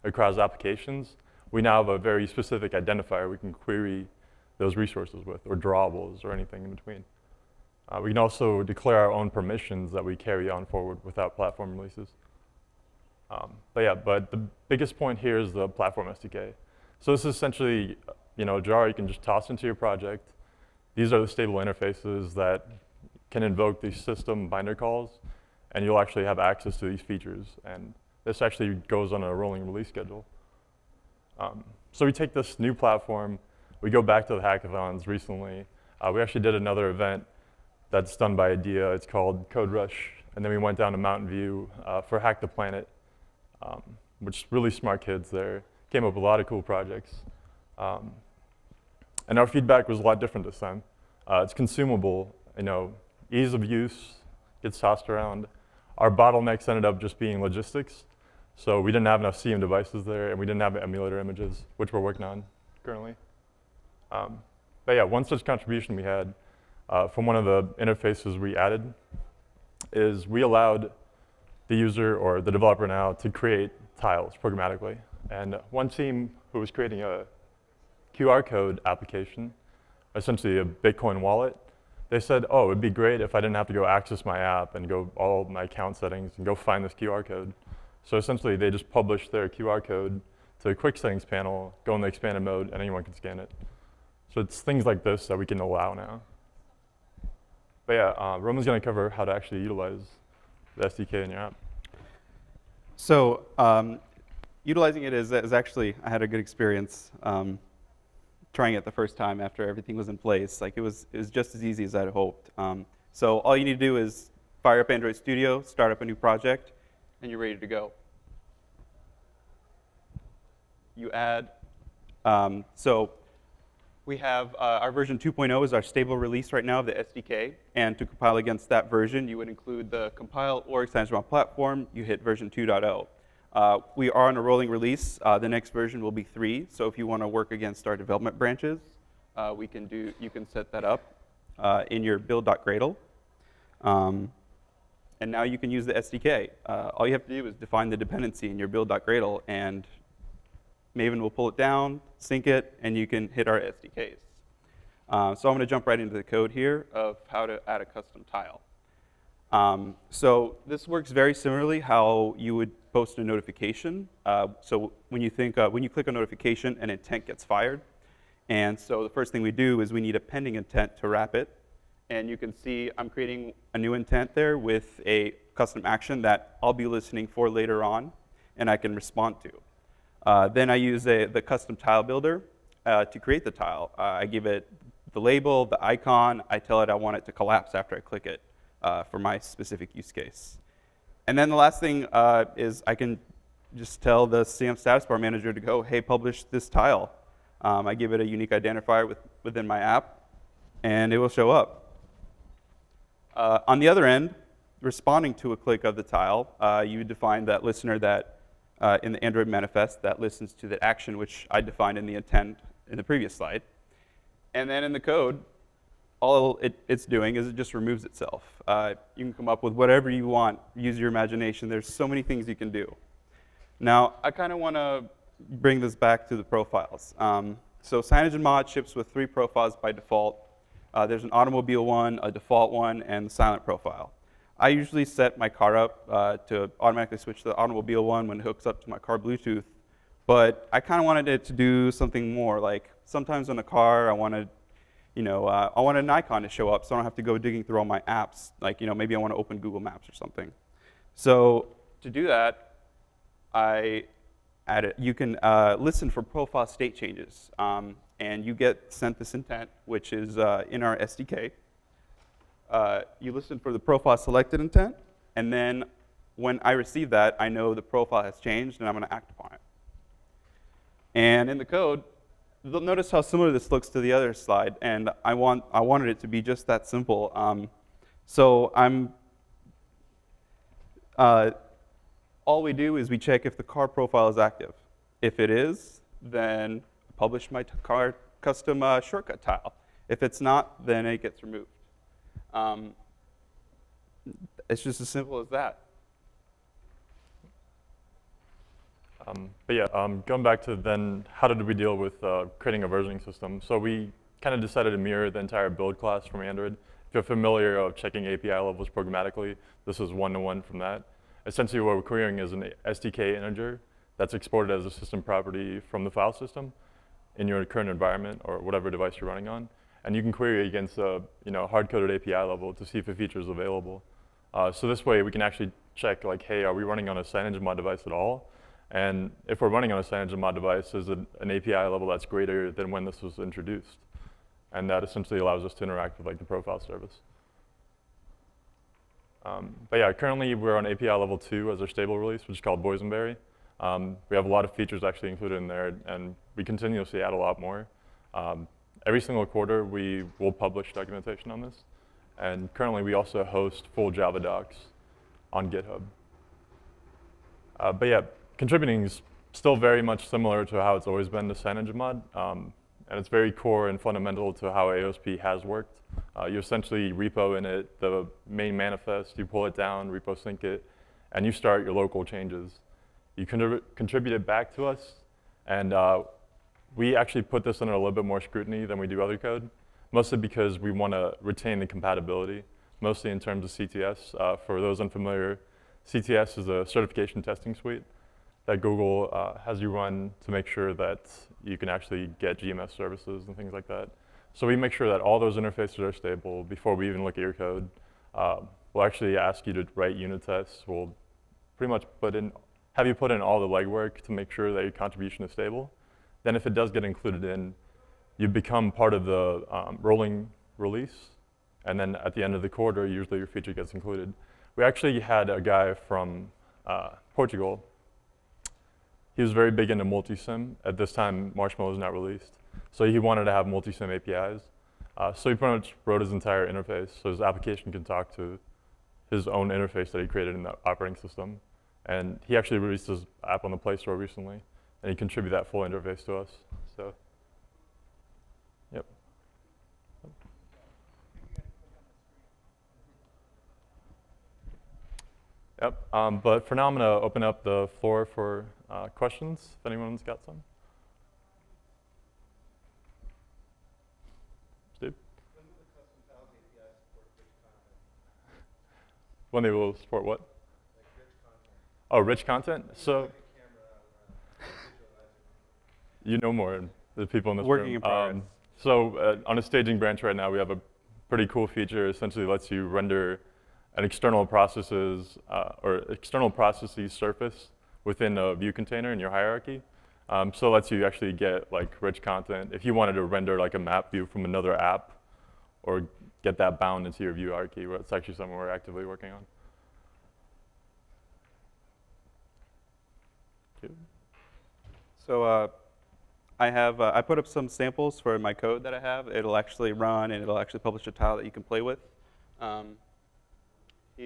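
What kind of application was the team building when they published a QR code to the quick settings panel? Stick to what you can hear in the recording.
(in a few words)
A Bitcoin wallet.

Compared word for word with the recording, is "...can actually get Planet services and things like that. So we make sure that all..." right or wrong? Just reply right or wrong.
wrong.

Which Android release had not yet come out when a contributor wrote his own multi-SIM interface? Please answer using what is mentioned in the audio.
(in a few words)
Marshmallow.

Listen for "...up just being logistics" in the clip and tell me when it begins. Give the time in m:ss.
0:56.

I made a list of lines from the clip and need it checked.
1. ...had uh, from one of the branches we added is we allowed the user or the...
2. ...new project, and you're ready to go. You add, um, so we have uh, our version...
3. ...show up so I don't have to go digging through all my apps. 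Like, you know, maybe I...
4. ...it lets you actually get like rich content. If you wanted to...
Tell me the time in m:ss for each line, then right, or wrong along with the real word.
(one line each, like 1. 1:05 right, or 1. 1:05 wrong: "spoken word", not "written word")
1. 1:06 wrong: "interfaces", not "branches"
2. 1:56 right
3. 4:06 right
4. 8:00 right.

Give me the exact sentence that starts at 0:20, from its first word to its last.
These are the stable interfaces that can invoke these system binder calls, and you'll actually have access to these features.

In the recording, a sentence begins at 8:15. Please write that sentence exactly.
So uh, I have, uh, I put up some samples for my code that I have.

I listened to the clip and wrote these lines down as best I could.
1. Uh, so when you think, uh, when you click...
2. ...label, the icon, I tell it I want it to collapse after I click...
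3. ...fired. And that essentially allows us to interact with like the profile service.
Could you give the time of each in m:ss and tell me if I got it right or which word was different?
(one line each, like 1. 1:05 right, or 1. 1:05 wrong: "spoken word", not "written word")
1. 2:44 right
2. 3:05 right
3. 5:33 wrong: "introduced", not "fired".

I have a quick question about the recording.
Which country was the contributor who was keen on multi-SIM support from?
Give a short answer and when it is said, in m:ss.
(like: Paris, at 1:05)
Portugal, at 6:57.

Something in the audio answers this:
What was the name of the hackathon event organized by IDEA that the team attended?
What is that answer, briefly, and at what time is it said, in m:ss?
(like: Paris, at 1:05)
Code Rush, at 0:39.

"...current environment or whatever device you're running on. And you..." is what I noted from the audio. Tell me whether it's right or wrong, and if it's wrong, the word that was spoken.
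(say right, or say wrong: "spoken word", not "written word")
right.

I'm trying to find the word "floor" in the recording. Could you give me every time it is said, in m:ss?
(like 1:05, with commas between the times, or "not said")
7:28.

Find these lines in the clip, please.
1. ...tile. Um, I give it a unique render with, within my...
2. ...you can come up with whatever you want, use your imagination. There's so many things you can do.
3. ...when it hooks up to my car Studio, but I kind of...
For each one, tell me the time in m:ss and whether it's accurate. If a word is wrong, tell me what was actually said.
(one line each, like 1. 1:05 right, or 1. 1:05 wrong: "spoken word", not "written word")
1. 3:16 wrong: "identifier", not "render"
2. 3:39 right
3. 3:58 wrong: "Bluetooth", not "Studio".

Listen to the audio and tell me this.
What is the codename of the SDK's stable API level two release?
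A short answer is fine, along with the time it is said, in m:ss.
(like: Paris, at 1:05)
Boysenberry, at 5:42.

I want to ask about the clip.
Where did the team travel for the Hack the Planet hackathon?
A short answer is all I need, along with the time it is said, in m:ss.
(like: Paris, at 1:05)
Mountain View, at 0:40.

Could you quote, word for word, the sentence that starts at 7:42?
So, you know more than the people in this Working room.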